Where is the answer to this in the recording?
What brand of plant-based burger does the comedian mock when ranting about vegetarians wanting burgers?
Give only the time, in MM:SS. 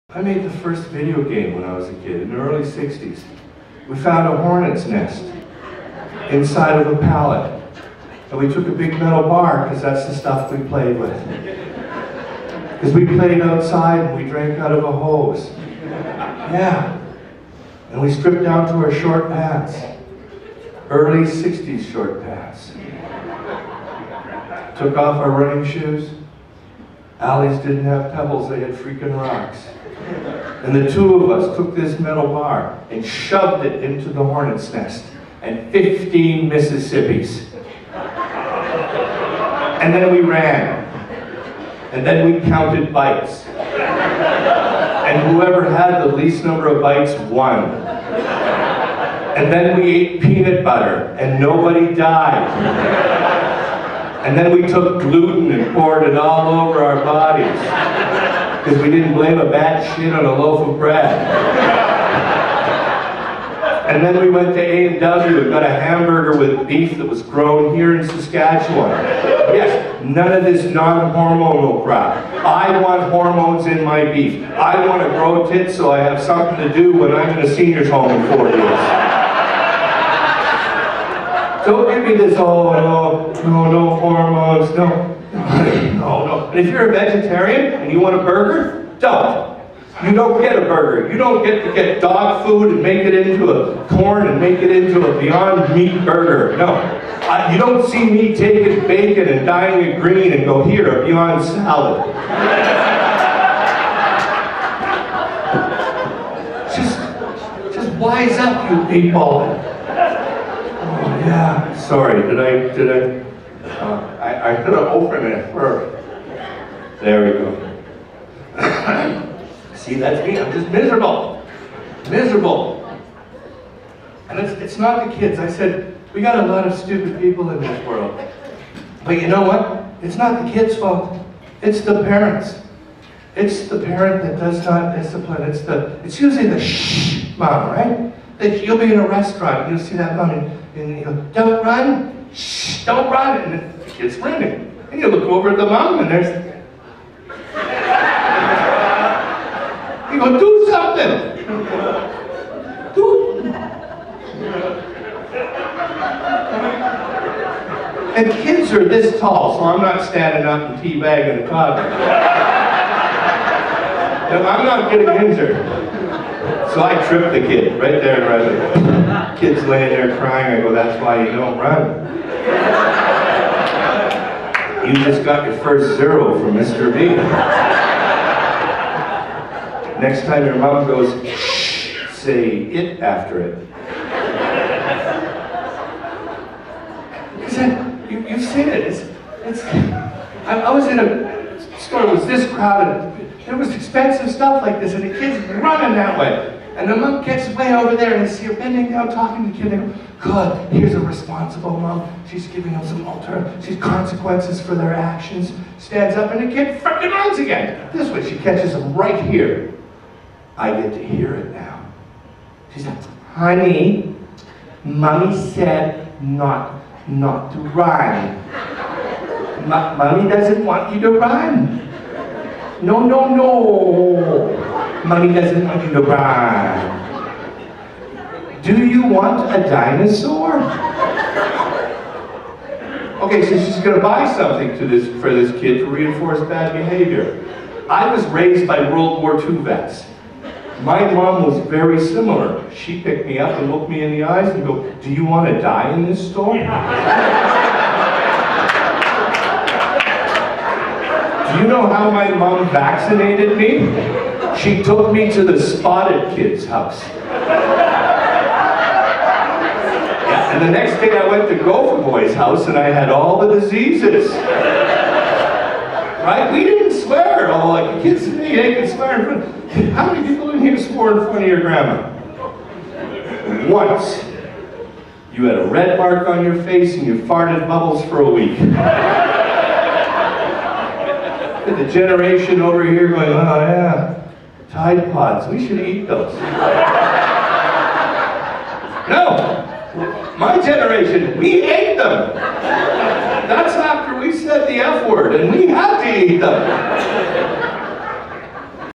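01:35.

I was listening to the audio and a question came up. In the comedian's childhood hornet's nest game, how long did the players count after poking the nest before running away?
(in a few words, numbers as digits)
15 Mississippis.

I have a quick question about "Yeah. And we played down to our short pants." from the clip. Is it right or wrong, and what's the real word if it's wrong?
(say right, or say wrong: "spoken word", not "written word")
wrong: "stripped", not "played".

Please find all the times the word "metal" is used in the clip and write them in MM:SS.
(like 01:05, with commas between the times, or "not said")
00:08, 00:31.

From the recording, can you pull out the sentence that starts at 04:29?
How many people in here swore in front of your grandma?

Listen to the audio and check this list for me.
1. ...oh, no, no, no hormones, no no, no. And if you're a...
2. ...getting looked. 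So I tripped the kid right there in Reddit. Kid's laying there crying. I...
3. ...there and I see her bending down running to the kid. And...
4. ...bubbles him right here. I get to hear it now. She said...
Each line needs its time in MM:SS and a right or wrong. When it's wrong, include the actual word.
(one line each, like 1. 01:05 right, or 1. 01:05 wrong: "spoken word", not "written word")
1. 01:22 right
2. 02:44 wrong: "injured", not "looked"
3. 03:17 wrong: "talking", not "running"
4. 03:28 wrong: "catches", not "bubbles".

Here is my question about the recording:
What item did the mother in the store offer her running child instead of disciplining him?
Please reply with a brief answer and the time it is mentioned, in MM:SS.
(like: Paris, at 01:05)
a dinosaur, at 03:49.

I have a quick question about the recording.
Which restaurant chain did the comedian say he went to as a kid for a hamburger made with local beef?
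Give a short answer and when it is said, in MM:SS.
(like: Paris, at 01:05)
A&W, at 01:04.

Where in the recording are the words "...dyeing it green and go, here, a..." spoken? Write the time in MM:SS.
01:39.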